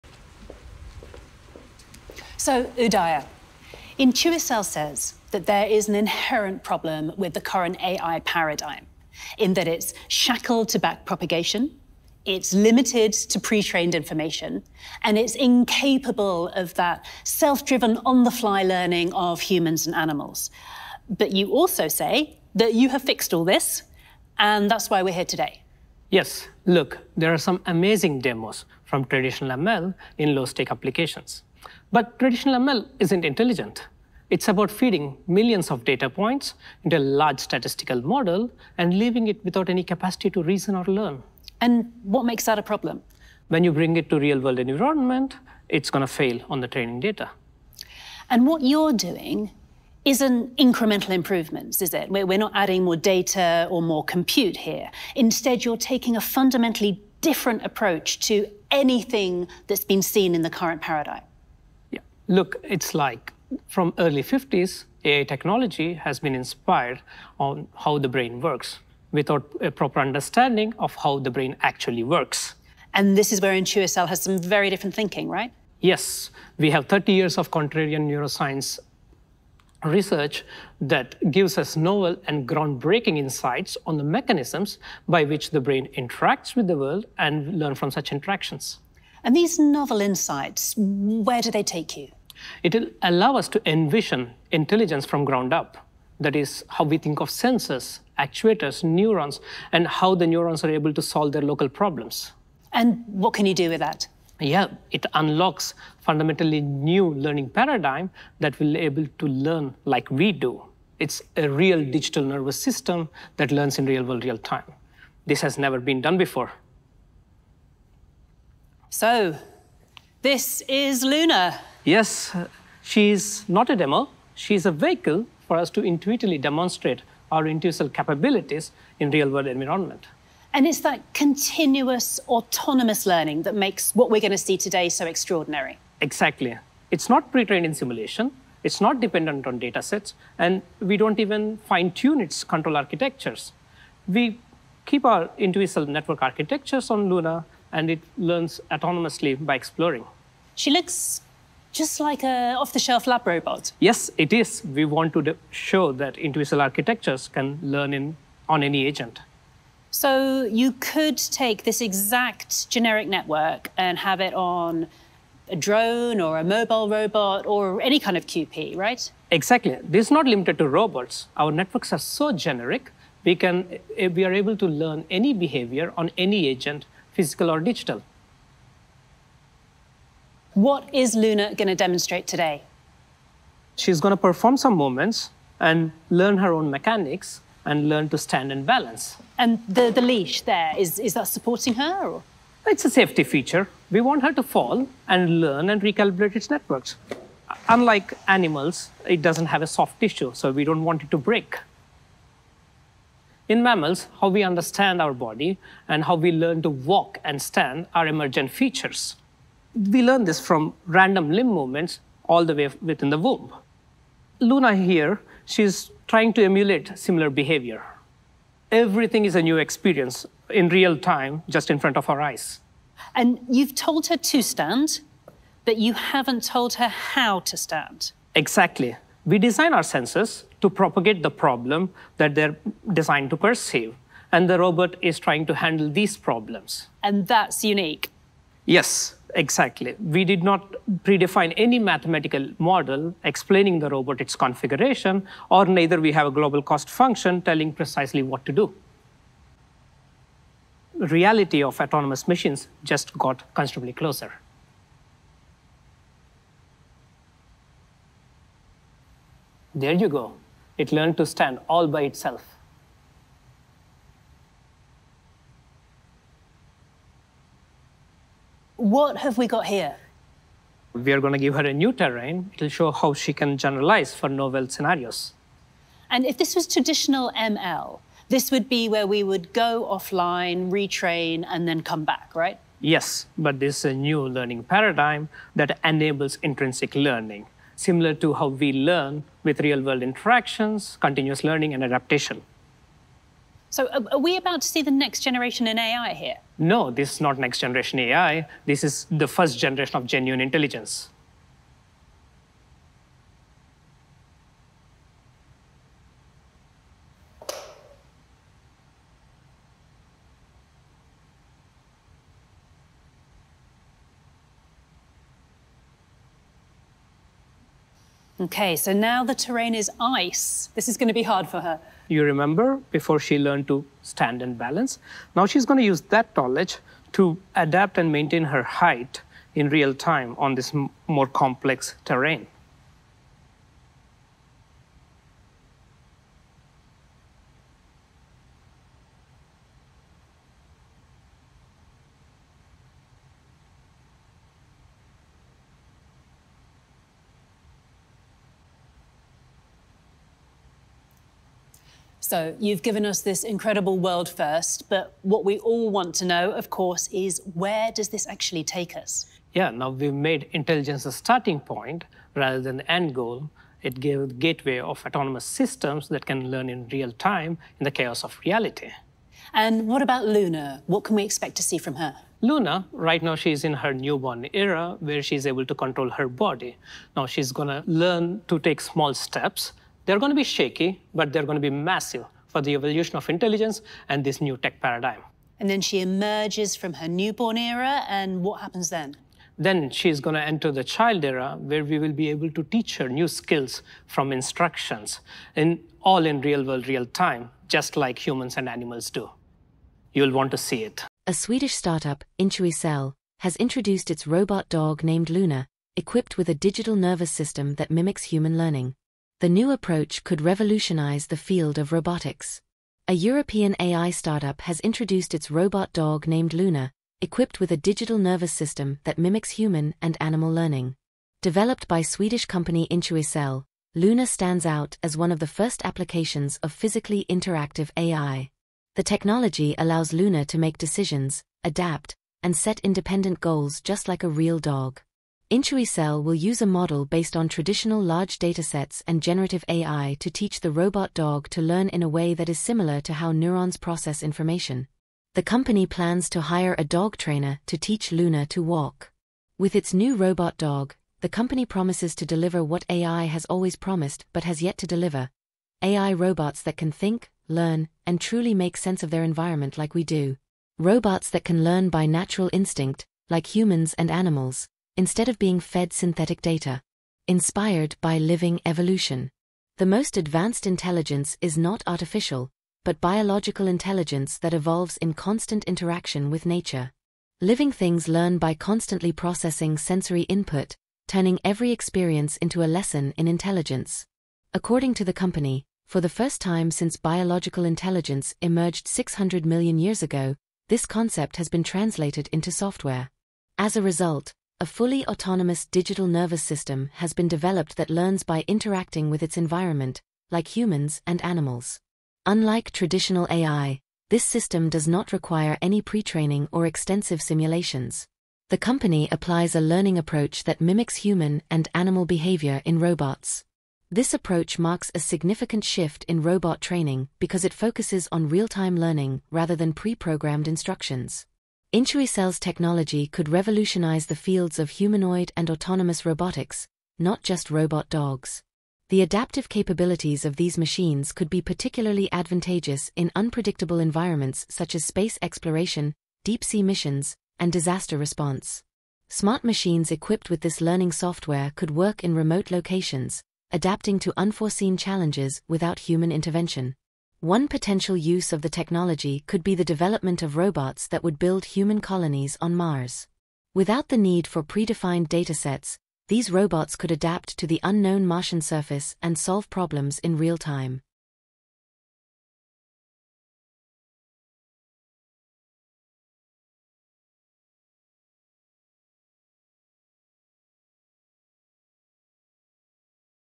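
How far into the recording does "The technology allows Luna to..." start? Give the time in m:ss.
7:08.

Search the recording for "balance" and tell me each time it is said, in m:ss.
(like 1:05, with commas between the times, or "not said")
3:08, 5:24.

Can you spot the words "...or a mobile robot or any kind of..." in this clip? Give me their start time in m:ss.
2:46.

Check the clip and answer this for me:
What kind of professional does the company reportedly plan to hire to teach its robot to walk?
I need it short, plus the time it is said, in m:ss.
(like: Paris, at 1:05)
dog trainer, at 7:26.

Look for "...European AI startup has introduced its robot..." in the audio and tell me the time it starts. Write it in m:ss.
6:53.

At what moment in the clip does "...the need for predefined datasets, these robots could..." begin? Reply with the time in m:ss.
9:13.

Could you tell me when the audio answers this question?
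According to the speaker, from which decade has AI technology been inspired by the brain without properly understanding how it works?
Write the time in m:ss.
1:03.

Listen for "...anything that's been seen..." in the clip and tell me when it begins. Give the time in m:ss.
0:58.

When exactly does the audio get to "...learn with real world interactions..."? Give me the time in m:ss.
4:48.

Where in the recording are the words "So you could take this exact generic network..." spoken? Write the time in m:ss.
2:39.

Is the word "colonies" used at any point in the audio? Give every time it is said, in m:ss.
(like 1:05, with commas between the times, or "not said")
9:11.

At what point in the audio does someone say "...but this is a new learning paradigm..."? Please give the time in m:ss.
4:43.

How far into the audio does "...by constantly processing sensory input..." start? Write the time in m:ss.
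7:58.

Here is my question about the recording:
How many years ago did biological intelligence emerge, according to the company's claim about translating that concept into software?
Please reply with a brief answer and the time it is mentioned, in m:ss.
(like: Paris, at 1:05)
600 million years, at 8:08.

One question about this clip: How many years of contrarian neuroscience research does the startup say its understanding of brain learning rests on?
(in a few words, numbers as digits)
30 years.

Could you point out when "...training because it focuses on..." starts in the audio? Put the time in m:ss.
8:36.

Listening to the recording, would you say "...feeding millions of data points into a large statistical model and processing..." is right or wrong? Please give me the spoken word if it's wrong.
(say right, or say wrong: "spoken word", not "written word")
wrong: "leaving", not "processing".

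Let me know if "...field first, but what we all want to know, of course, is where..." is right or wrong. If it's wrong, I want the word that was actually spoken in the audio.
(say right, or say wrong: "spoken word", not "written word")
wrong: "world", not "field".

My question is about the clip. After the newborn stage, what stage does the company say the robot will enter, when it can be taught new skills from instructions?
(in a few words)
child era.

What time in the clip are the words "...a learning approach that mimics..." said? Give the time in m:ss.
8:29.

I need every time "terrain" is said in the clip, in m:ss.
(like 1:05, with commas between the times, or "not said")
4:31, 5:19, 5:32.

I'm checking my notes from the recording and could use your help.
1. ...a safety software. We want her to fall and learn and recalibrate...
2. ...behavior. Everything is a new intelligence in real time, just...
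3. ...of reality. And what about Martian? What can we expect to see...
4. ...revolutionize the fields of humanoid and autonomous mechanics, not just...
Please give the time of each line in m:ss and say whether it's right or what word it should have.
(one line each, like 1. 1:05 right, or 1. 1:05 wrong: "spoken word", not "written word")
1. 3:12 wrong: "feature", not "software"
2. 3:37 wrong: "experience", not "intelligence"
3. 6:08 wrong: "Luna", not "Martian"
4. 8:43 wrong: "robotics", not "mechanics".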